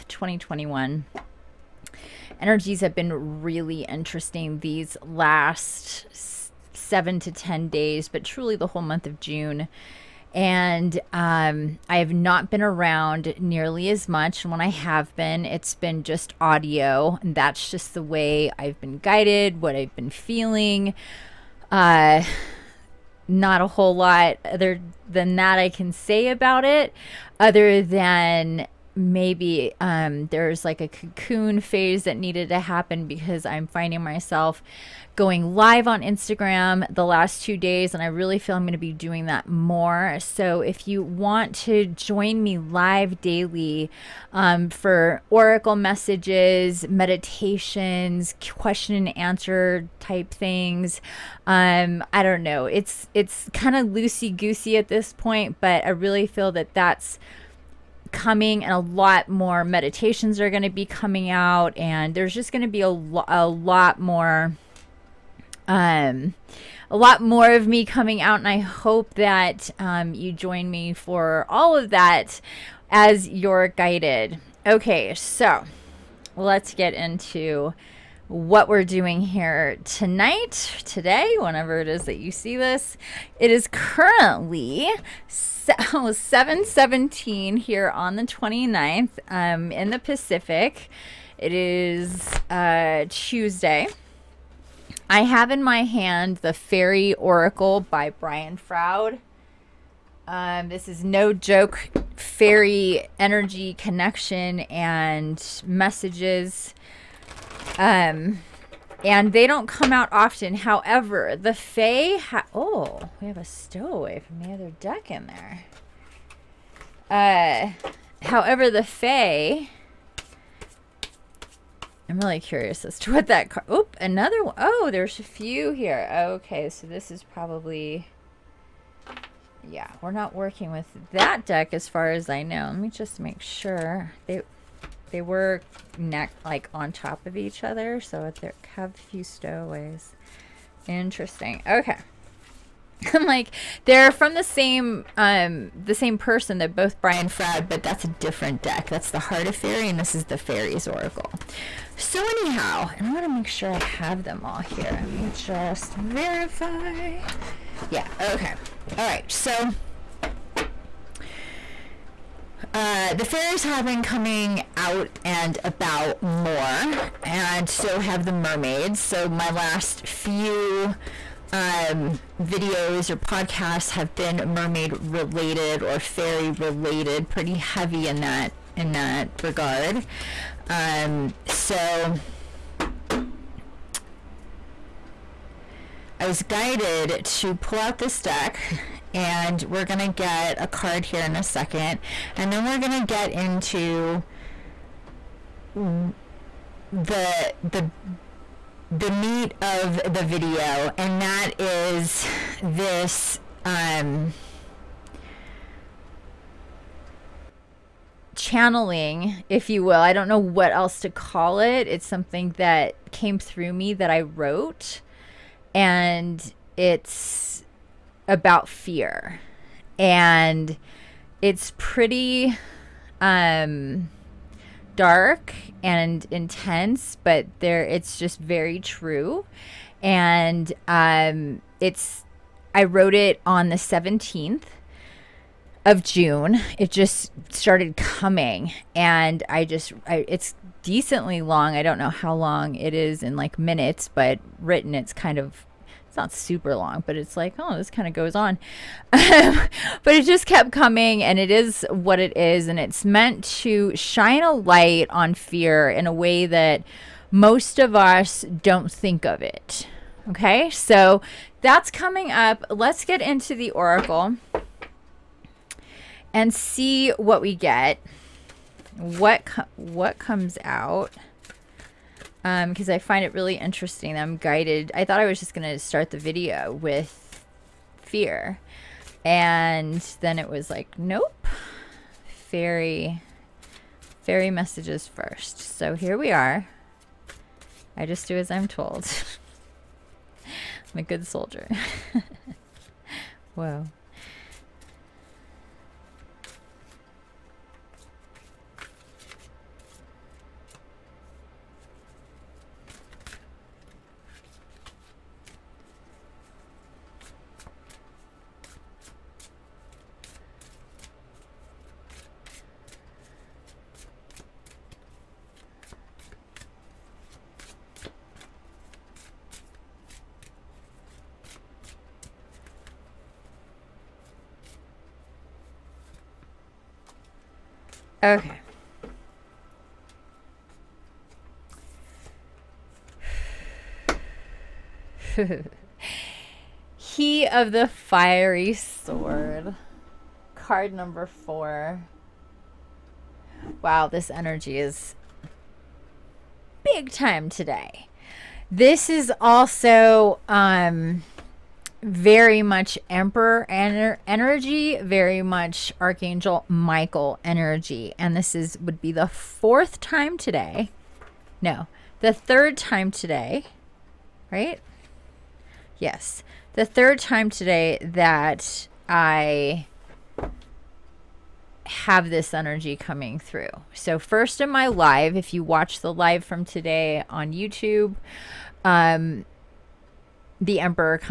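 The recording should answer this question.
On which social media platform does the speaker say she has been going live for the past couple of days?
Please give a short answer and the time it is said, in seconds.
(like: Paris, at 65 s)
Instagram, at 36 s.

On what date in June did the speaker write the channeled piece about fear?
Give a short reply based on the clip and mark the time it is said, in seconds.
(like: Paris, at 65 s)
June 17, at 233 s.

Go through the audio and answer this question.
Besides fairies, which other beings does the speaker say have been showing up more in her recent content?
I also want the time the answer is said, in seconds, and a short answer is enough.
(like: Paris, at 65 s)
mermaids, at 168 s.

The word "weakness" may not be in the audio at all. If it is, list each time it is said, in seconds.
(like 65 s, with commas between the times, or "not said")
not said.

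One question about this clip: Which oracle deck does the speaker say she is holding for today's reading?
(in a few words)
The Fairy Oracle.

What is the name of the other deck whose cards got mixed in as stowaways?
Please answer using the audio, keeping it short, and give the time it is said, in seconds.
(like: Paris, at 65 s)
Heart of Faerie, at 149 s.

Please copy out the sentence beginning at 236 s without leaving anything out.
It just started coming and I just I, it's decently long.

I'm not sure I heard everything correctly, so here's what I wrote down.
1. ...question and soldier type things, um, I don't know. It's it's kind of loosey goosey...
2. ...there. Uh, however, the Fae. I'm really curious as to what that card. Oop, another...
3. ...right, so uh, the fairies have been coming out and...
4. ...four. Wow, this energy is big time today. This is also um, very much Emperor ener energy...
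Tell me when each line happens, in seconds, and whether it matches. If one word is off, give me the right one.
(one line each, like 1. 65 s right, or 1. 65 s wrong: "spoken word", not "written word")
1. 48 s wrong: "answer", not "soldier"
2. 115 s right
3. 159 s right
4. 341 s right.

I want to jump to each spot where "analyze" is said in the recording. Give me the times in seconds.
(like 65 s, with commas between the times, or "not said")
not said.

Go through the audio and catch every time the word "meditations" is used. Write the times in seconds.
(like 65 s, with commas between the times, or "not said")
46 s, 59 s.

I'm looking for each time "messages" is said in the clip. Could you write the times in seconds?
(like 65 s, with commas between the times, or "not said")
45 s, 105 s, 284 s.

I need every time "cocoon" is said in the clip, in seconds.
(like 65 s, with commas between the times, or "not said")
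30 s.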